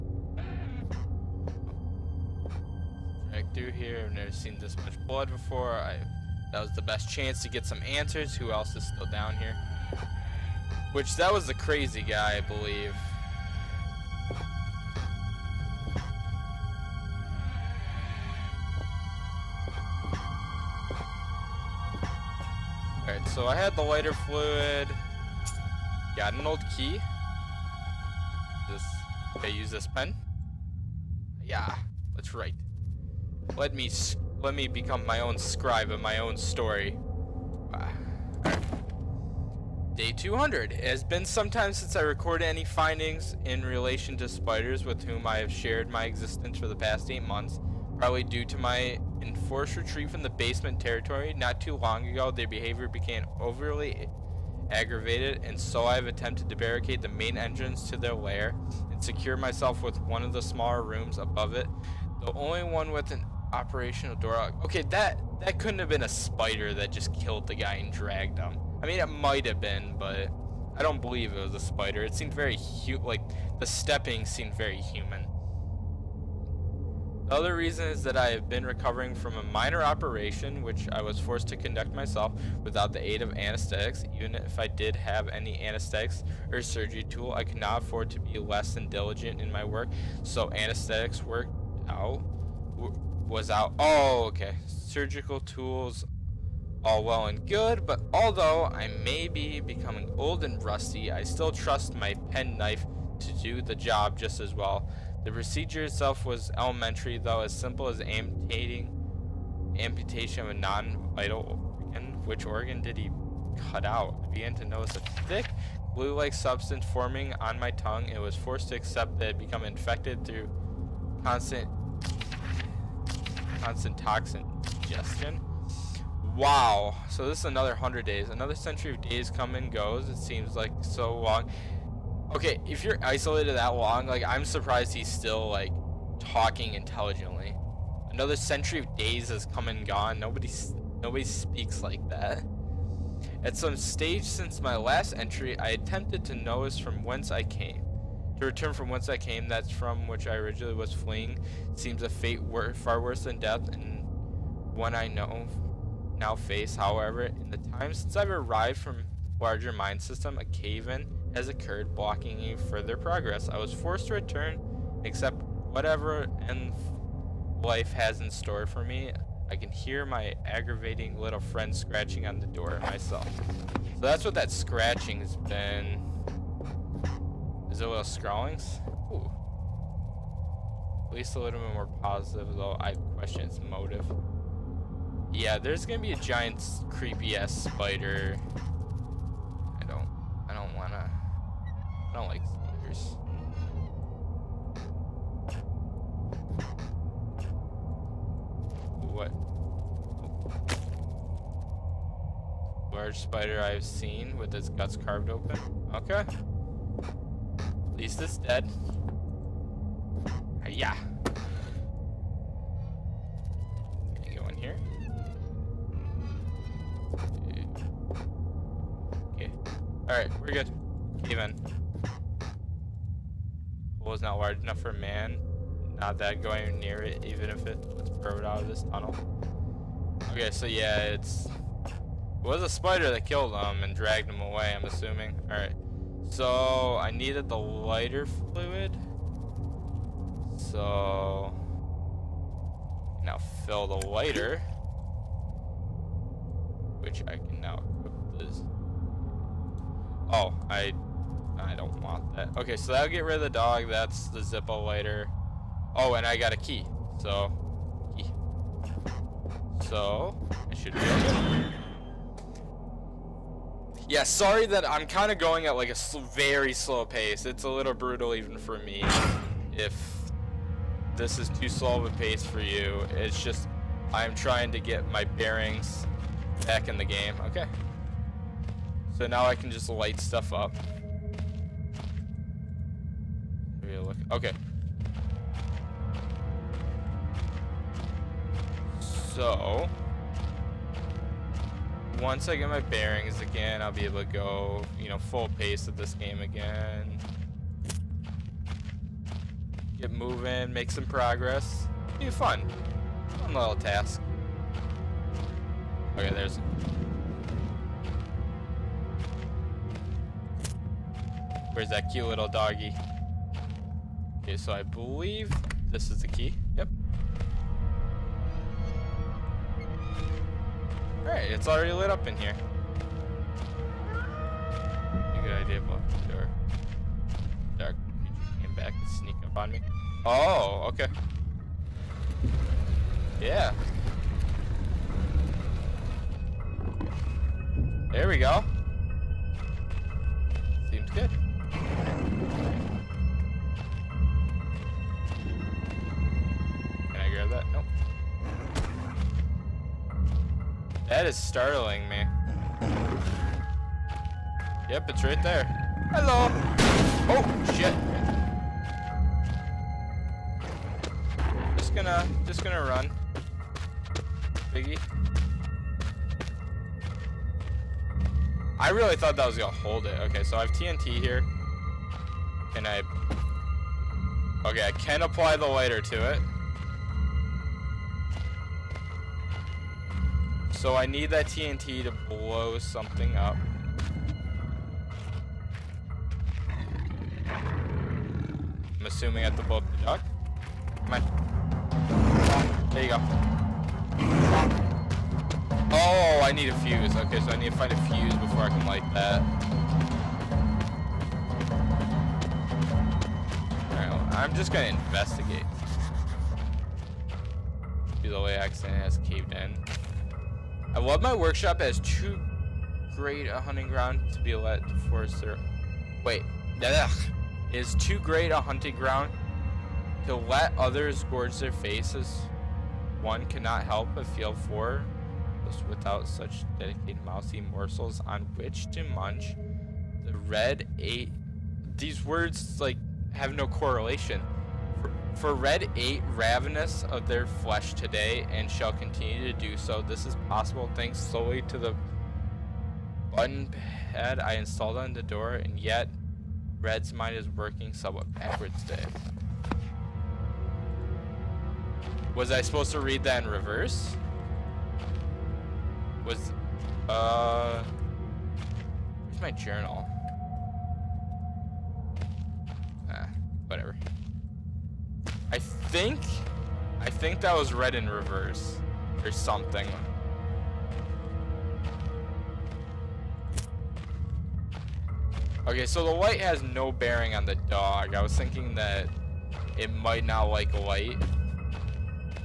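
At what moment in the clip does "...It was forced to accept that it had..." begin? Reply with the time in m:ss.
1:58.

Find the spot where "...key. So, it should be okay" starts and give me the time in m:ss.
4:18.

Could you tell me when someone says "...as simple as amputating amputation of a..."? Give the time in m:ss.
1:47.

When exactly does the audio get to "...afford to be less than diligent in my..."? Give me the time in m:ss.
1:27.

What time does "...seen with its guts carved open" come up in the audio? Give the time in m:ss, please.
3:23.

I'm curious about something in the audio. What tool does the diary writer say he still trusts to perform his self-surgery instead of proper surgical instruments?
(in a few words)
penknife.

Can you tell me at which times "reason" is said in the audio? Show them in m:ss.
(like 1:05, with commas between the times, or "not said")
1:17.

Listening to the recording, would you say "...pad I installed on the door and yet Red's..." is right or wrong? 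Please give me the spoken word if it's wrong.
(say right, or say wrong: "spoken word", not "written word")
right.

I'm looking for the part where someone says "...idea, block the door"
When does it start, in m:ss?
5:25.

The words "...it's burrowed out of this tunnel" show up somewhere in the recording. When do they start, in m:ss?
3:47.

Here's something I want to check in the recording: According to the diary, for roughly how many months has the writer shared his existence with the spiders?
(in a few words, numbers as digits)
8.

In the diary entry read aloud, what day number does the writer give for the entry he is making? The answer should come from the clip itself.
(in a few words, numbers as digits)
Day 200.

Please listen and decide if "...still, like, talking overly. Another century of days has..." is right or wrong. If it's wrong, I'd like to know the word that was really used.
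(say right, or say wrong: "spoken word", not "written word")
wrong: "intelligently", not "overly".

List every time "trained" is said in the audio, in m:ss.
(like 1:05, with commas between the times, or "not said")
not said.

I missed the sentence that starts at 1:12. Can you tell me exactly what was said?
It seemed very hu like the stepping seemed very human.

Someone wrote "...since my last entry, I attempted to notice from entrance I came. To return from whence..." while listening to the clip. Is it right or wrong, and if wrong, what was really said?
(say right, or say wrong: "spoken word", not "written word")
wrong: "whence", not "entrance".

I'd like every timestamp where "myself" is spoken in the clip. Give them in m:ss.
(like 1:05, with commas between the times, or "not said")
0:59, 1:21, 2:52.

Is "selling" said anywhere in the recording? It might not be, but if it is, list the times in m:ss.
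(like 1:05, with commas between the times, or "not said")
not said.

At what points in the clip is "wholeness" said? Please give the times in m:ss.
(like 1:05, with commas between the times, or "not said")
not said.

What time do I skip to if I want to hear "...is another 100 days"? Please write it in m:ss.
2:07.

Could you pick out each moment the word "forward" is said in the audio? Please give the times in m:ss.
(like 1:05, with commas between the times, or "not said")
not said.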